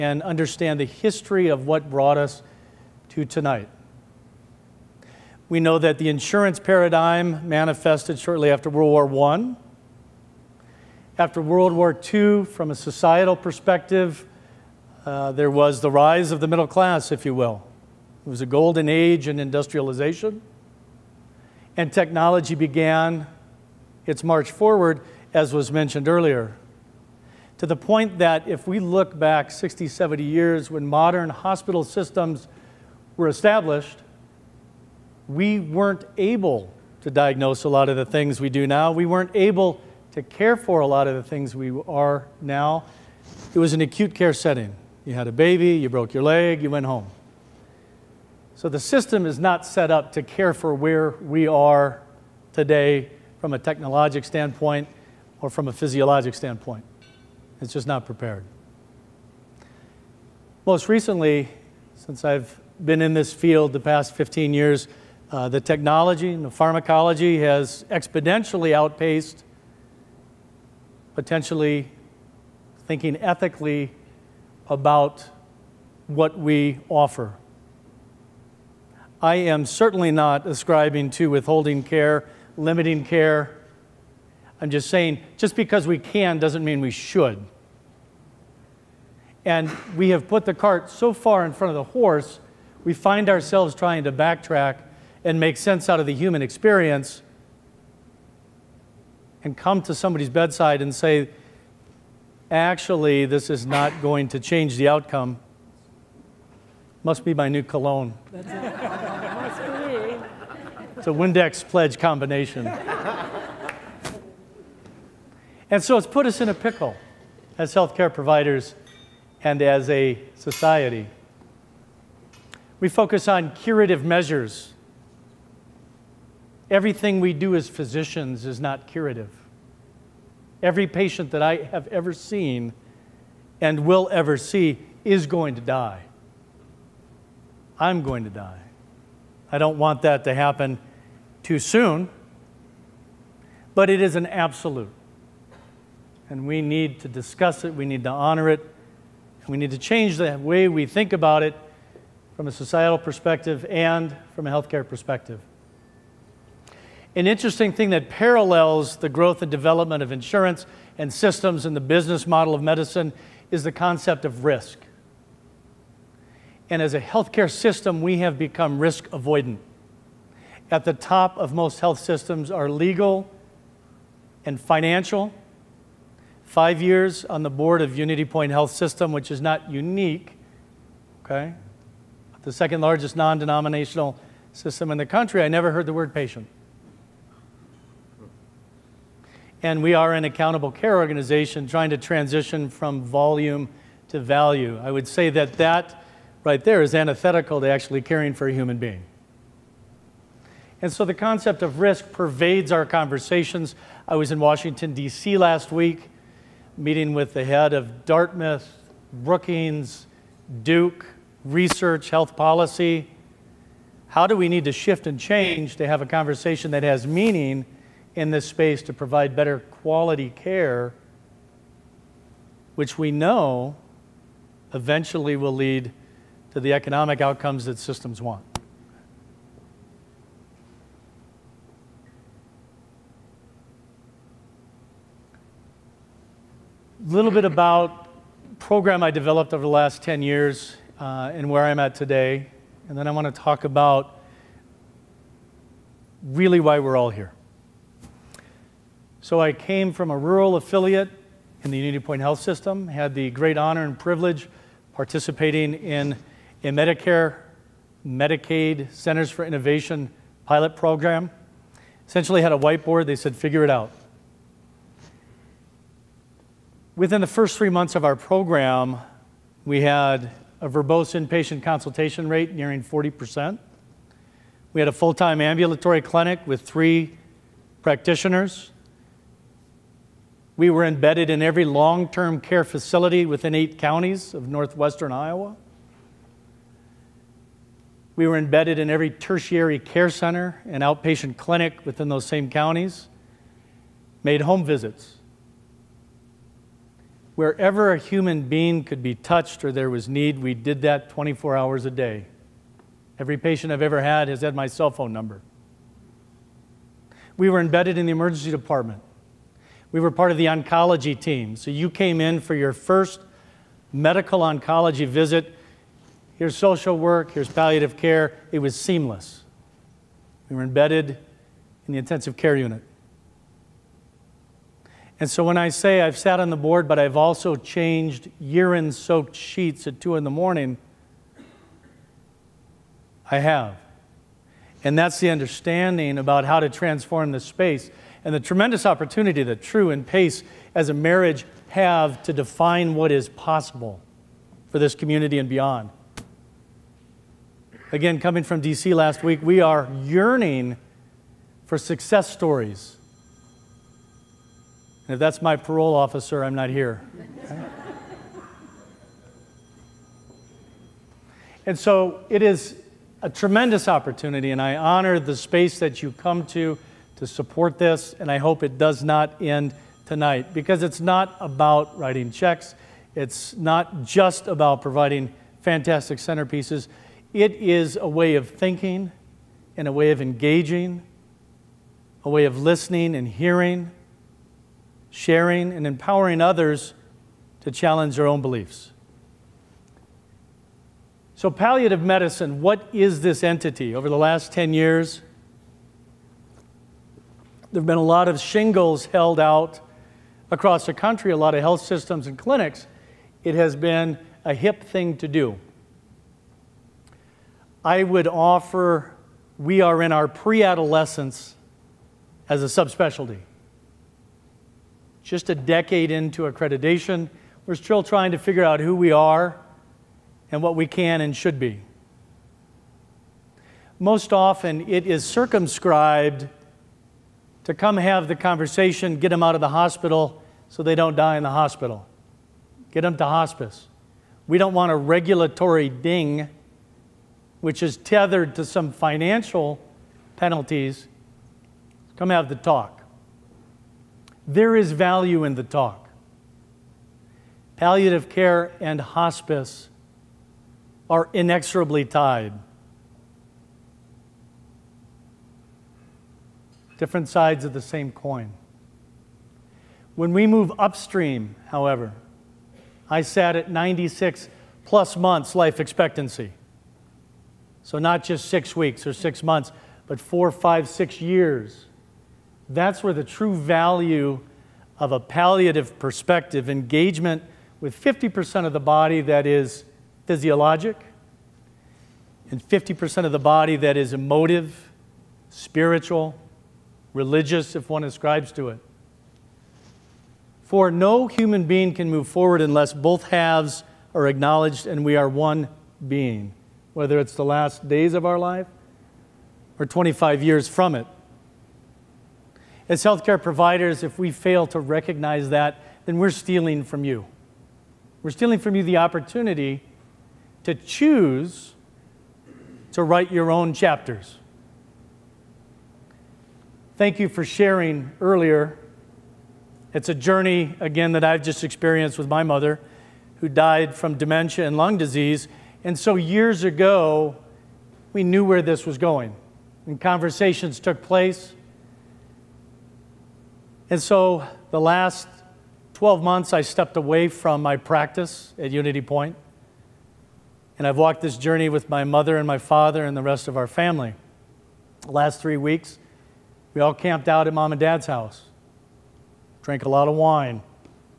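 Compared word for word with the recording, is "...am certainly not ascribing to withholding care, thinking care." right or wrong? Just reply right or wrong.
wrong.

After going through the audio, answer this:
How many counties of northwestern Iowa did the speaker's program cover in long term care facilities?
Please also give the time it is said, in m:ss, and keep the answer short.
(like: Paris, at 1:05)
8, at 4:43.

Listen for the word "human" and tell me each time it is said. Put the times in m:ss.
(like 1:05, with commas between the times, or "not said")
1:36, 3:18, 4:57, 8:11.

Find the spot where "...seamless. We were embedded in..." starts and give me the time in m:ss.
5:18.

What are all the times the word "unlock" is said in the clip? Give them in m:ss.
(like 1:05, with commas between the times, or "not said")
not said.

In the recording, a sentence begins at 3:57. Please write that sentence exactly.
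a little bit about program I developed over the last 10 years uh, and where I'm at today.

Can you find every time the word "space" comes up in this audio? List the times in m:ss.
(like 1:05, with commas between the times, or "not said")
3:38, 5:37, 6:05.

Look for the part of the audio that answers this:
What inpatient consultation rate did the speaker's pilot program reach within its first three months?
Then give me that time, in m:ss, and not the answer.
4:32.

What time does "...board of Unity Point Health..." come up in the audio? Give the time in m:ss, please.
2:57.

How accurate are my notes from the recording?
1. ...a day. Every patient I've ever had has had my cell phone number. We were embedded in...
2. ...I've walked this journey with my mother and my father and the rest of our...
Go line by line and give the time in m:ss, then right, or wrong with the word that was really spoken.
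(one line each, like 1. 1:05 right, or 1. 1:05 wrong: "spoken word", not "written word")
1. 5:01 right
2. 9:00 right.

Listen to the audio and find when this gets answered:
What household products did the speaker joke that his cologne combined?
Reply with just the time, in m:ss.
1:51.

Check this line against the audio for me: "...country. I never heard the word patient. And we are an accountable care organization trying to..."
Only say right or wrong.
right.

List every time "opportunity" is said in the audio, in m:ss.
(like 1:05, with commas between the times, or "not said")
5:38, 6:03, 8:28.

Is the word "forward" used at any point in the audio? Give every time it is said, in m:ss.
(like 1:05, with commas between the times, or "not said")
0:24, 8:12.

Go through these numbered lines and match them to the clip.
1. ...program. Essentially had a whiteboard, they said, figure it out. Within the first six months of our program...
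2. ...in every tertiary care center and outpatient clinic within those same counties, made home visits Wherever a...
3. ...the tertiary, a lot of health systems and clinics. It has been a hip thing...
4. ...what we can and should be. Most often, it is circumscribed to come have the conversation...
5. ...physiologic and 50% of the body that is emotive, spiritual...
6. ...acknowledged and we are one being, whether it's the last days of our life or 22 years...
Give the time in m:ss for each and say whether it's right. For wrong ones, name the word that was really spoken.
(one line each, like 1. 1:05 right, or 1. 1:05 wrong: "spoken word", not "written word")
1. 4:20 wrong: "three", not "six"
2. 4:48 right
3. 6:40 wrong: "country", not "tertiary"
4. 7:00 right
5. 8:00 right
6. 8:14 wrong: "25", not "22".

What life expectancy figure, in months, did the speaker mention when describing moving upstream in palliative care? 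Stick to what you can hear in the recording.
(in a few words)
96.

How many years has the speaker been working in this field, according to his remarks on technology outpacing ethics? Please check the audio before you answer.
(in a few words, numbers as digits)
15.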